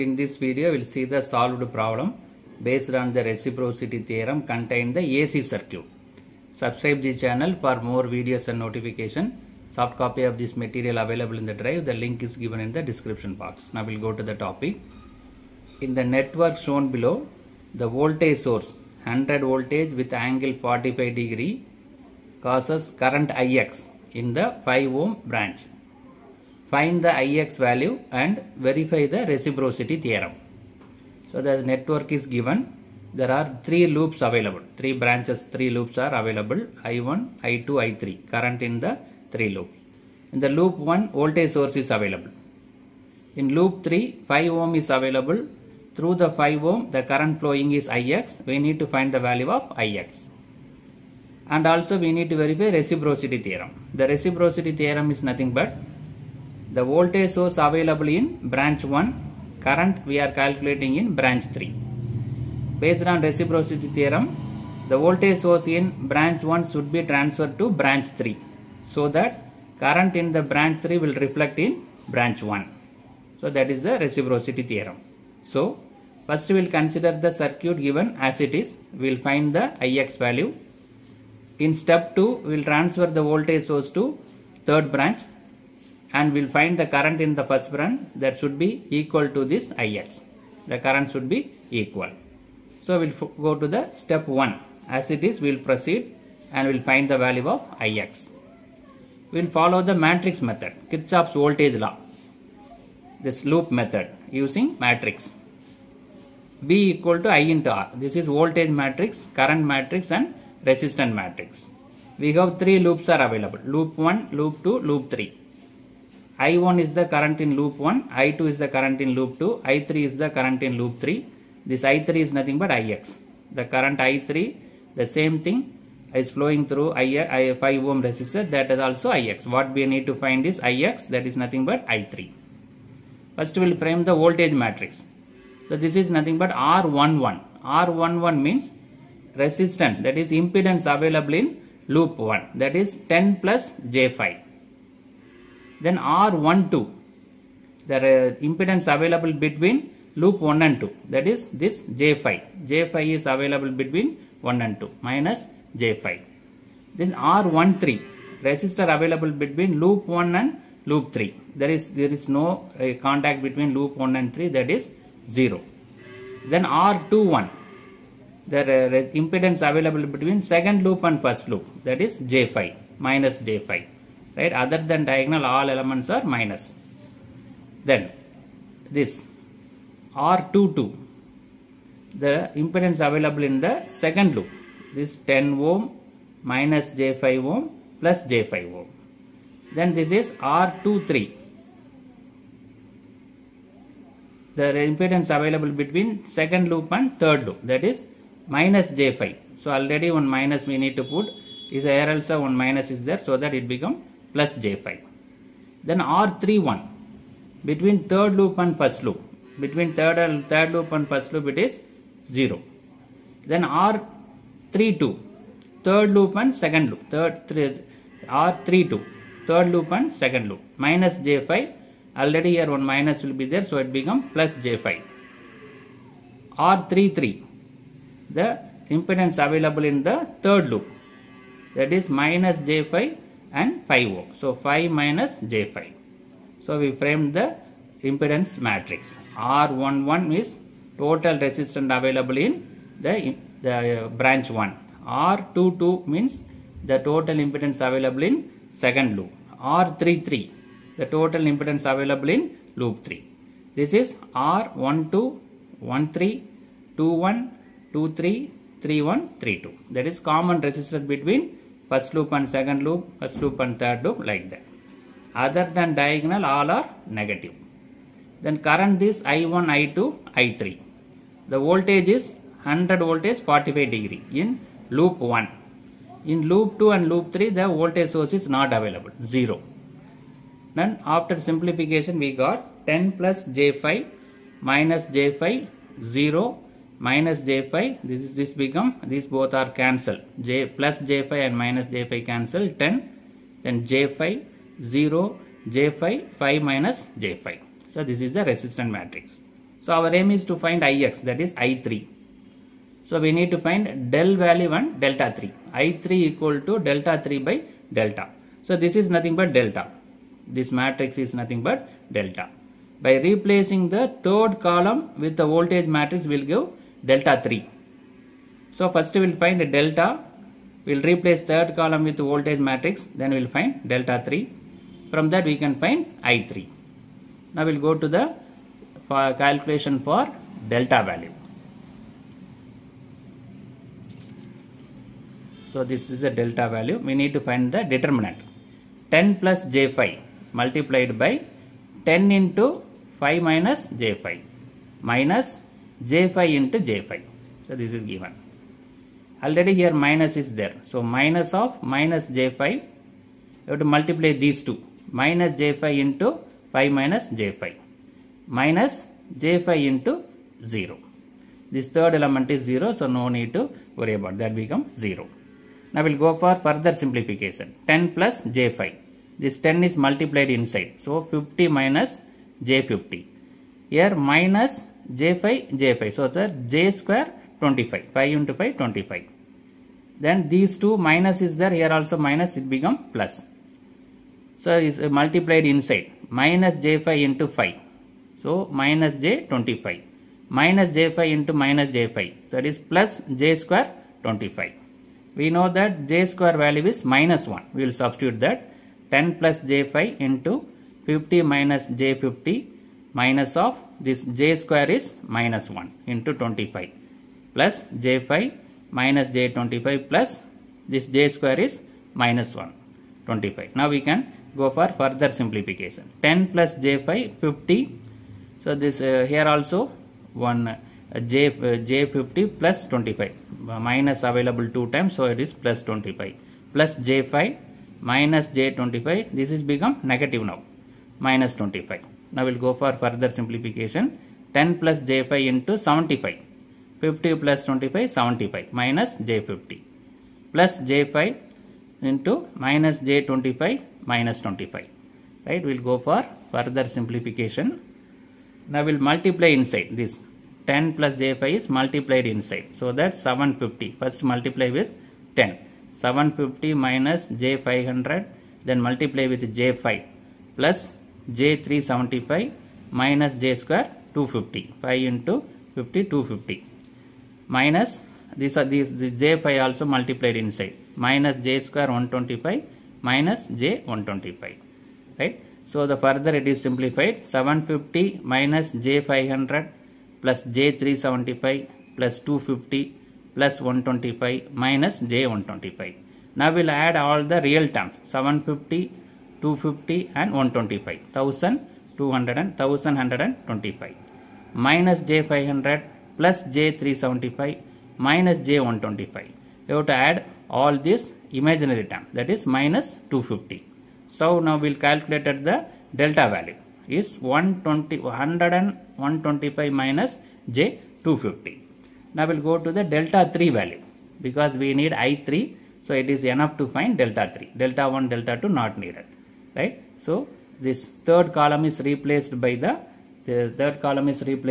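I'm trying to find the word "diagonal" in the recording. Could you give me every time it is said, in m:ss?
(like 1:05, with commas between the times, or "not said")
2:55, 4:25.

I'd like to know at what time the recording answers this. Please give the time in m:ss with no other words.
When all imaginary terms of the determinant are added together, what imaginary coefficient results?
8:22.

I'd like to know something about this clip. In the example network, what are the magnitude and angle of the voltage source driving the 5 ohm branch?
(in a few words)
100 V at 45 degrees.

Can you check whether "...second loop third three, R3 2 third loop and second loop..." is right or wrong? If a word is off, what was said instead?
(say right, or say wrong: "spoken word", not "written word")
right.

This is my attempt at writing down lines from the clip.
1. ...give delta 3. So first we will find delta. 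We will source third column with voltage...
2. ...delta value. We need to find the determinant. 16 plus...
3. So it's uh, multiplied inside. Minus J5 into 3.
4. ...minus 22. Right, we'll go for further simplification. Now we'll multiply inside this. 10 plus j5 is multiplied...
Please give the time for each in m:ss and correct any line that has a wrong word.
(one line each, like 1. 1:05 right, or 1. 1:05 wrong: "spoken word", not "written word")
1. 5:16 wrong: "replace", not "source"
2. 5:36 wrong: "10", not "16"
3. 6:24 wrong: "5", not "3"
4. 7:24 wrong: "25", not "22".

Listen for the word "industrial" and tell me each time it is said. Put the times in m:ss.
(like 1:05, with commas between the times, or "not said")
not said.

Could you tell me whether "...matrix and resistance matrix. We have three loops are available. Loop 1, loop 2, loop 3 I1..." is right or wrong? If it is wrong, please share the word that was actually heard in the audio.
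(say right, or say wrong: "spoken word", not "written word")
right.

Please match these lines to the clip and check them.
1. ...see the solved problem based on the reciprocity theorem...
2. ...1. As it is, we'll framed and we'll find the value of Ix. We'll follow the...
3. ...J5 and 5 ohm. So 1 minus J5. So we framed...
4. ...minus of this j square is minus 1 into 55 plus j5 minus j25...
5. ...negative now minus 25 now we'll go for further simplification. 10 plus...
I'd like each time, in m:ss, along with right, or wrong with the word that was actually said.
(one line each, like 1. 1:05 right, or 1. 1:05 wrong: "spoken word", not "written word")
1. 0:00 right
2. 1:34 wrong: "proceed", not "framed"
3. 3:52 wrong: "5", not "1"
4. 6:43 wrong: "25", not "55"
5. 7:10 right.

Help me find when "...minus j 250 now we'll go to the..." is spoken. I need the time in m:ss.
8:29.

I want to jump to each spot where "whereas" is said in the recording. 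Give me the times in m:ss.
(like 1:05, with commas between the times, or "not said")
not said.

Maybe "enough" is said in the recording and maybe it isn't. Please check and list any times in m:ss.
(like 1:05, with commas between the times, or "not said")
8:36.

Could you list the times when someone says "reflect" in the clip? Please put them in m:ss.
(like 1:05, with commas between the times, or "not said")
1:11.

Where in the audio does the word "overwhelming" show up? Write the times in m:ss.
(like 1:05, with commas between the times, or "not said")
not said.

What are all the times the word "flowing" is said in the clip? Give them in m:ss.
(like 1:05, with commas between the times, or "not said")
0:47, 2:06.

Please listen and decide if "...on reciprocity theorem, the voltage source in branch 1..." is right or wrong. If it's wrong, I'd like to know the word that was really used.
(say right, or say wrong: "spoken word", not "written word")
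right.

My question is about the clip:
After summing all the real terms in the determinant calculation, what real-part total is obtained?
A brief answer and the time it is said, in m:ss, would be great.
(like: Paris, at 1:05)
1125, at 8:12.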